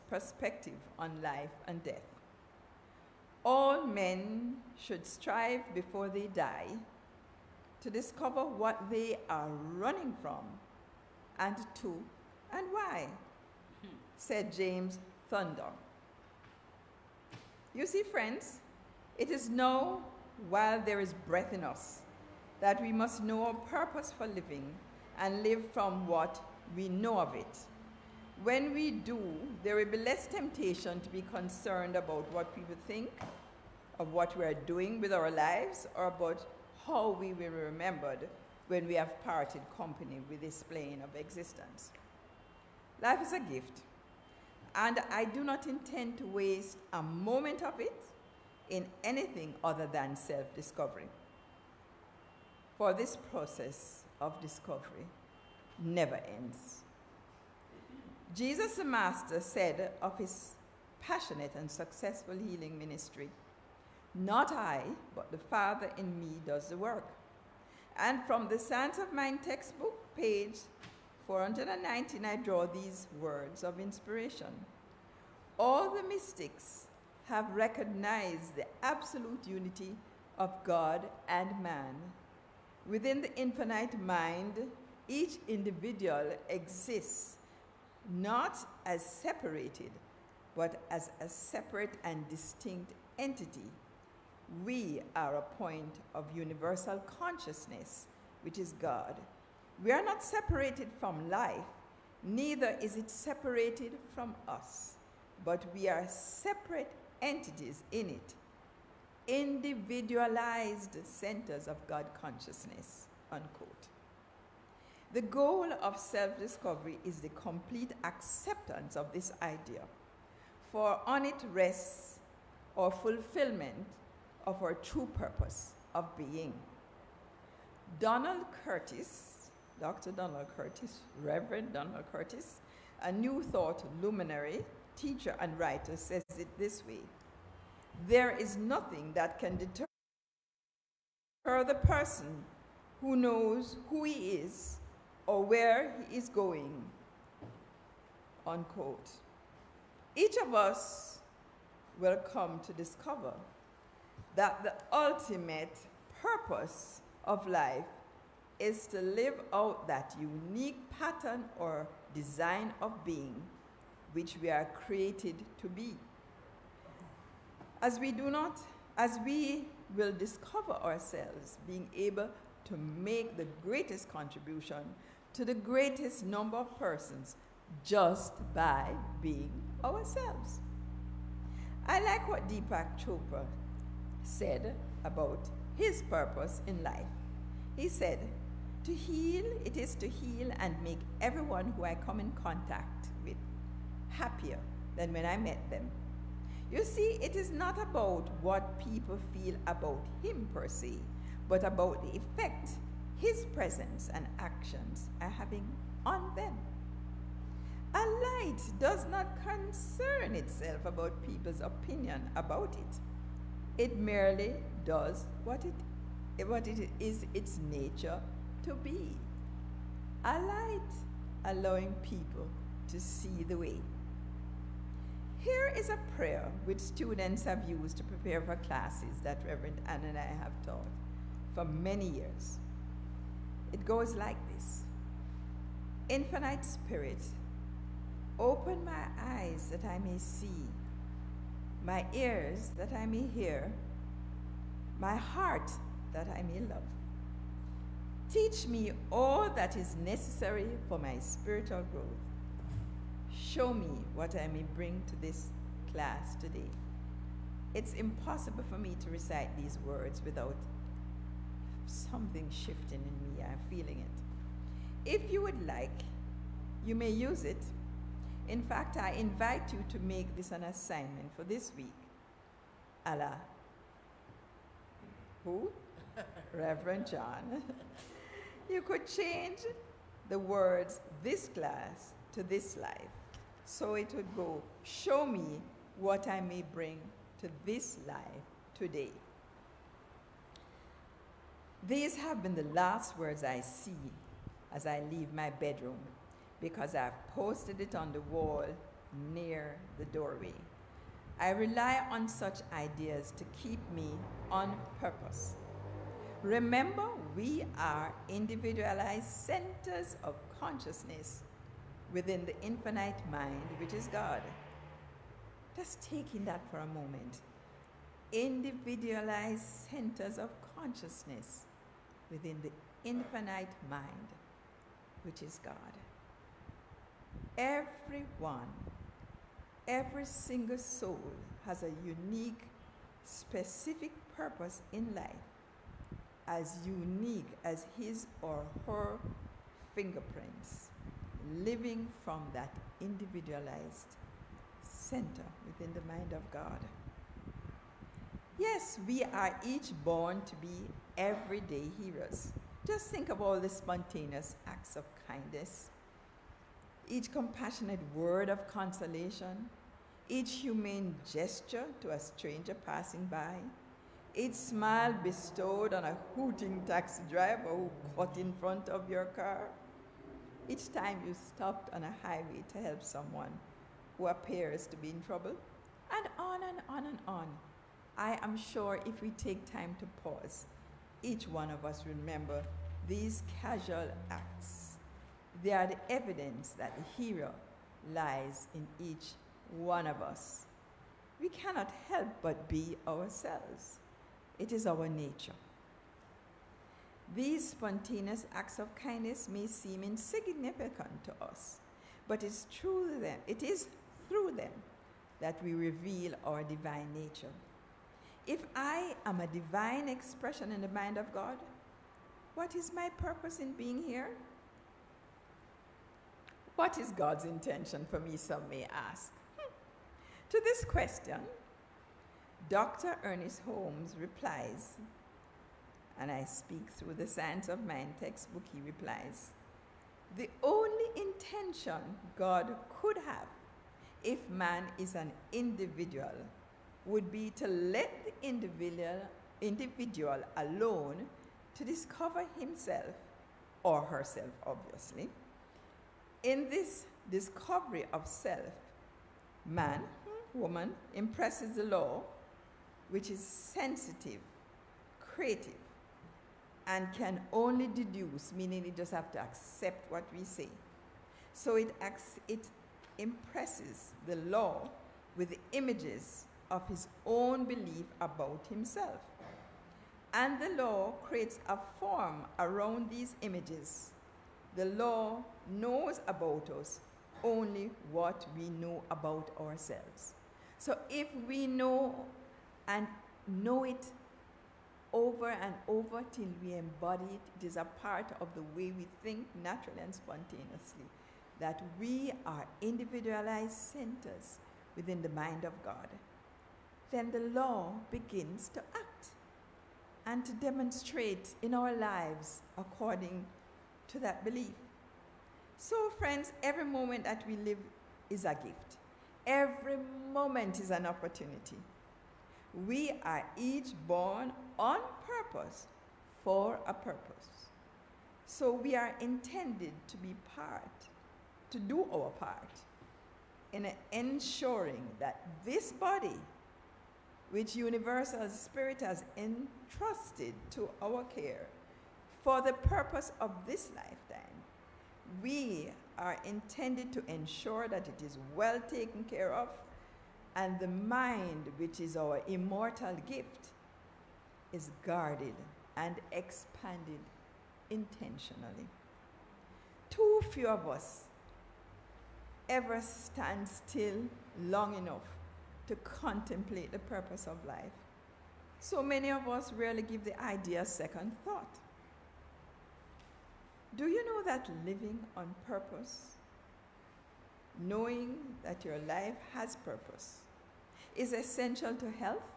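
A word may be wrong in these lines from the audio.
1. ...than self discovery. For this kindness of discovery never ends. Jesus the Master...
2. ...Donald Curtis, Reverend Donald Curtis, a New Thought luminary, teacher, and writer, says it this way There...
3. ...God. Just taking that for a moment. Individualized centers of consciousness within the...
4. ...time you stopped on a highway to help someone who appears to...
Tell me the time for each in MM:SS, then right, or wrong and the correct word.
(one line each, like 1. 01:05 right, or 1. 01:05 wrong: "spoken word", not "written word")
1. 00:49 wrong: "process", not "kindness"
2. 02:10 right
3. 05:14 right
4. 06:10 right.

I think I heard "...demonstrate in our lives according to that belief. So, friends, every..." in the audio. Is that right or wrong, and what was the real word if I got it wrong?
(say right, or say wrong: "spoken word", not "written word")
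right.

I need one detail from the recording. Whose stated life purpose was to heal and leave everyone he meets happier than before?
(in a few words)
Deepak Chopra.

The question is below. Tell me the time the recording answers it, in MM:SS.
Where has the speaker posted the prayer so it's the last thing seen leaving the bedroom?
04:57.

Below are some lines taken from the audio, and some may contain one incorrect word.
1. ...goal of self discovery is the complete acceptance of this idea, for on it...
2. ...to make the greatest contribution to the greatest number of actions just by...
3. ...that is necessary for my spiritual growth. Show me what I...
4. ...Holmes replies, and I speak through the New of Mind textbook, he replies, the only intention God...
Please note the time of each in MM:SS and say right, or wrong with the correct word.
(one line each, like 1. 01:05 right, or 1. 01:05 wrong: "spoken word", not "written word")
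1. 01:55 right
2. 02:52 wrong: "persons", not "actions"
3. 04:09 right
4. 07:03 wrong: "Science", not "New".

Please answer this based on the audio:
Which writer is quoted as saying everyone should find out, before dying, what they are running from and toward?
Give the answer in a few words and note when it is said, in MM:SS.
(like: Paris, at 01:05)
James Thurber, at 00:14.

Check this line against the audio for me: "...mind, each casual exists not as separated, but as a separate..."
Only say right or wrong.
wrong.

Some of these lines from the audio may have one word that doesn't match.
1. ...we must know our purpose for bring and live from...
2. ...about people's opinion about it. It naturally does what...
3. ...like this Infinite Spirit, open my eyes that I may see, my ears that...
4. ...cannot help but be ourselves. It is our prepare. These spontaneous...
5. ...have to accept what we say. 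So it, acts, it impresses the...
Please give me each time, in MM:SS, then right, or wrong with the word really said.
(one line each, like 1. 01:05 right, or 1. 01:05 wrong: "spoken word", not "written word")
1. 00:22 wrong: "living", not "bring"
2. 03:30 wrong: "merely", not "naturally"
3. 03:54 right
4. 06:31 wrong: "nature", not "prepare"
5. 07:39 right.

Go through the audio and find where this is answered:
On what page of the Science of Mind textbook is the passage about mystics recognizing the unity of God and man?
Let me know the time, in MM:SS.
01:11.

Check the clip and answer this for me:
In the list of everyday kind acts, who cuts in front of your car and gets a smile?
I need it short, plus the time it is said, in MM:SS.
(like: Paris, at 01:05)
a hooting taxi driver, at 06:06.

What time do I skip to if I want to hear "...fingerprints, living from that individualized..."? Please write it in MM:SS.
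05:39.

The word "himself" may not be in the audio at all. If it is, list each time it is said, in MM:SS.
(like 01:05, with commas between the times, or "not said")
07:22, 07:48.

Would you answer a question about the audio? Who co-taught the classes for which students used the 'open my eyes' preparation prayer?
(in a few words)
Reverend Ann.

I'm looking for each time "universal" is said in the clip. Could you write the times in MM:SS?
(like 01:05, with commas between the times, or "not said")
01:36, 08:47.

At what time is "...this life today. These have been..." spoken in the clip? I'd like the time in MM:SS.
04:47.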